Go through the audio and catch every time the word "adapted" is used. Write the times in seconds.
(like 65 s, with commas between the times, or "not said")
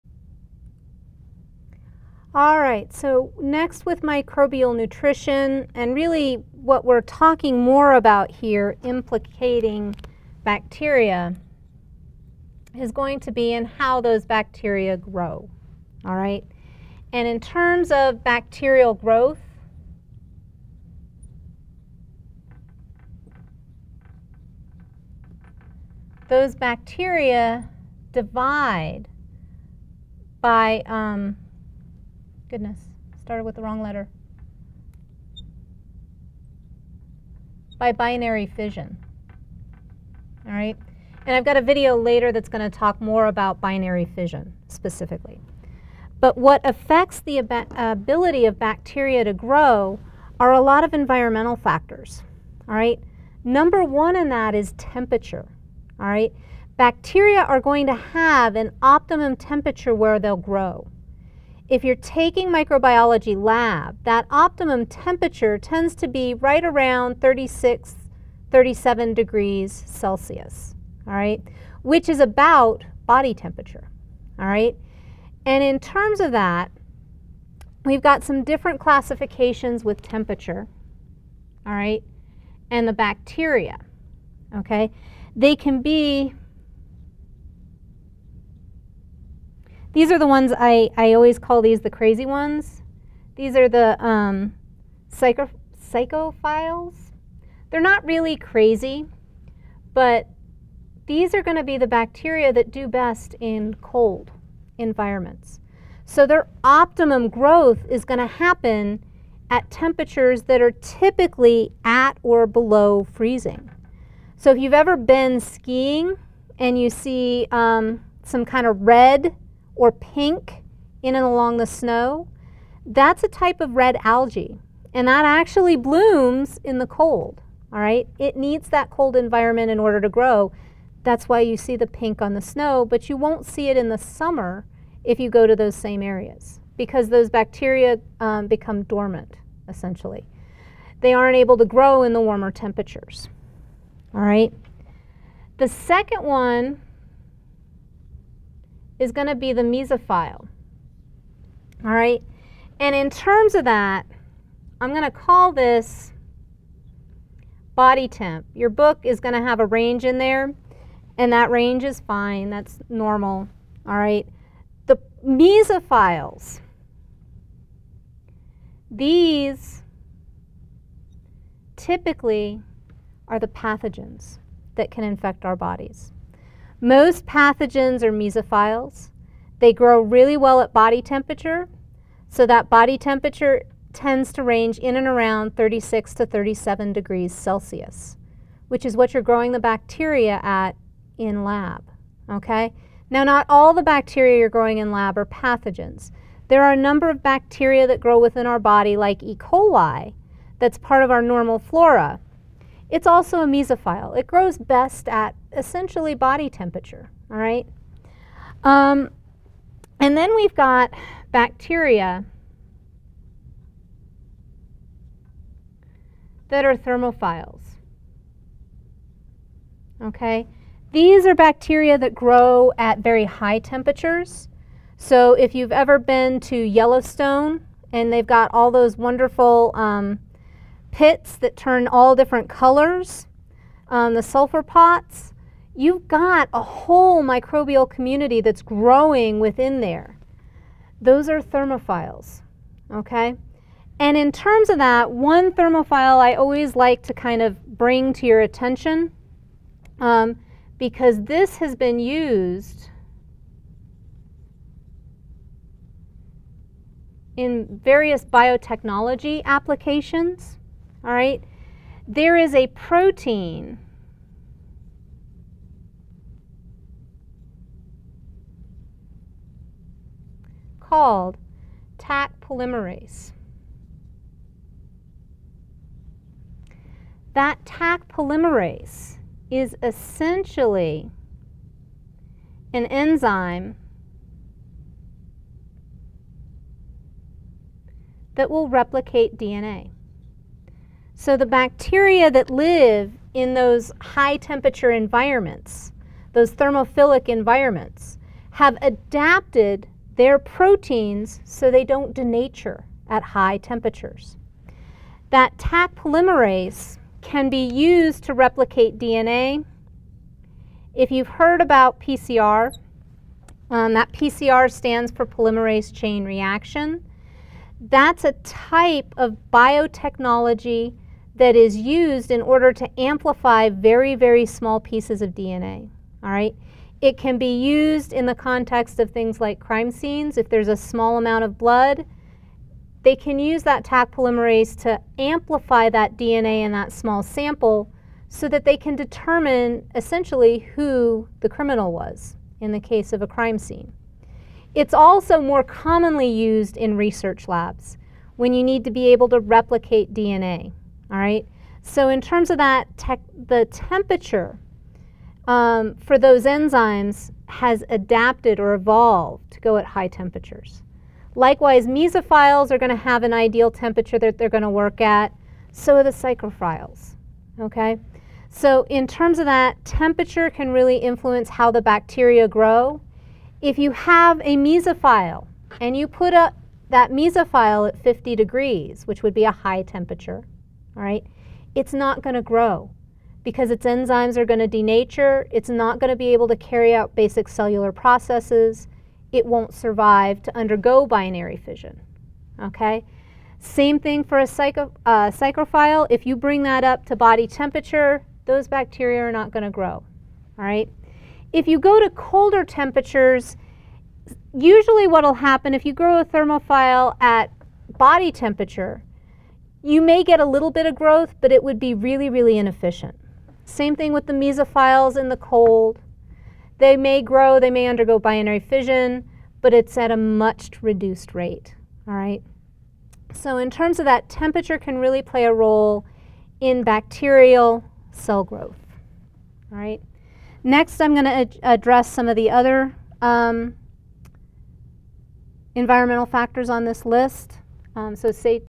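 298 s, 357 s.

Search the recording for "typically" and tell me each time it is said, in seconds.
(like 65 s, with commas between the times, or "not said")
110 s, 171 s.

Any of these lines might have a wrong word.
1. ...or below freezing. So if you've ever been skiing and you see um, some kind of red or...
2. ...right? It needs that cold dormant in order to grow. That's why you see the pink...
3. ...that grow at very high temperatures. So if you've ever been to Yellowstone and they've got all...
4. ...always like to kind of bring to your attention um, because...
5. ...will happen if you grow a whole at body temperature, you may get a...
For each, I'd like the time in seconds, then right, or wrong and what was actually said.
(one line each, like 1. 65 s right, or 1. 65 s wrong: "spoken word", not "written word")
1. 112 s right
2. 127 s wrong: "environment", not "dormant"
3. 221 s right
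4. 246 s right
5. 405 s wrong: "thermophile", not "whole".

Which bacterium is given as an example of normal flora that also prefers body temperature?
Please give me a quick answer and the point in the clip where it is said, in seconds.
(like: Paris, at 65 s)
E. coli, at 199 s.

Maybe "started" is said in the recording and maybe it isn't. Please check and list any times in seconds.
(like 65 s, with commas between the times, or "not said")
33 s.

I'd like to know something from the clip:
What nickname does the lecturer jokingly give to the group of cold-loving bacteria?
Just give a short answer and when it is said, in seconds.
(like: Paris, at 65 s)
the crazy ones, at 91 s.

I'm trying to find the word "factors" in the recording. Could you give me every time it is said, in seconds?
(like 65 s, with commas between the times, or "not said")
51 s, 436 s.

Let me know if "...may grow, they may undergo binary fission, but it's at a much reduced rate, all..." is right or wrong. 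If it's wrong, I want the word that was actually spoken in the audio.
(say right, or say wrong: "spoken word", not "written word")
right.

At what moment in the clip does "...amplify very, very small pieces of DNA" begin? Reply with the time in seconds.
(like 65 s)
322 s.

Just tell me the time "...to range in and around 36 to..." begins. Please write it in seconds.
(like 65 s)
184 s.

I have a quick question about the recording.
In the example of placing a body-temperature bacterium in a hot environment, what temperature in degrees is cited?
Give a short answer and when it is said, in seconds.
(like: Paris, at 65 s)
50 degrees, at 378 s.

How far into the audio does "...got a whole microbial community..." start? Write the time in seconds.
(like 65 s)
236 s.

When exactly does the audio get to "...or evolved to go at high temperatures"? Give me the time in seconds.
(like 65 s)
358 s.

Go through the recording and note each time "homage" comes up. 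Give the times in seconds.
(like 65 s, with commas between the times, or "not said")
not said.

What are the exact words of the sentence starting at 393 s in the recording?
Same thing for a psycho, uh, psychrophile.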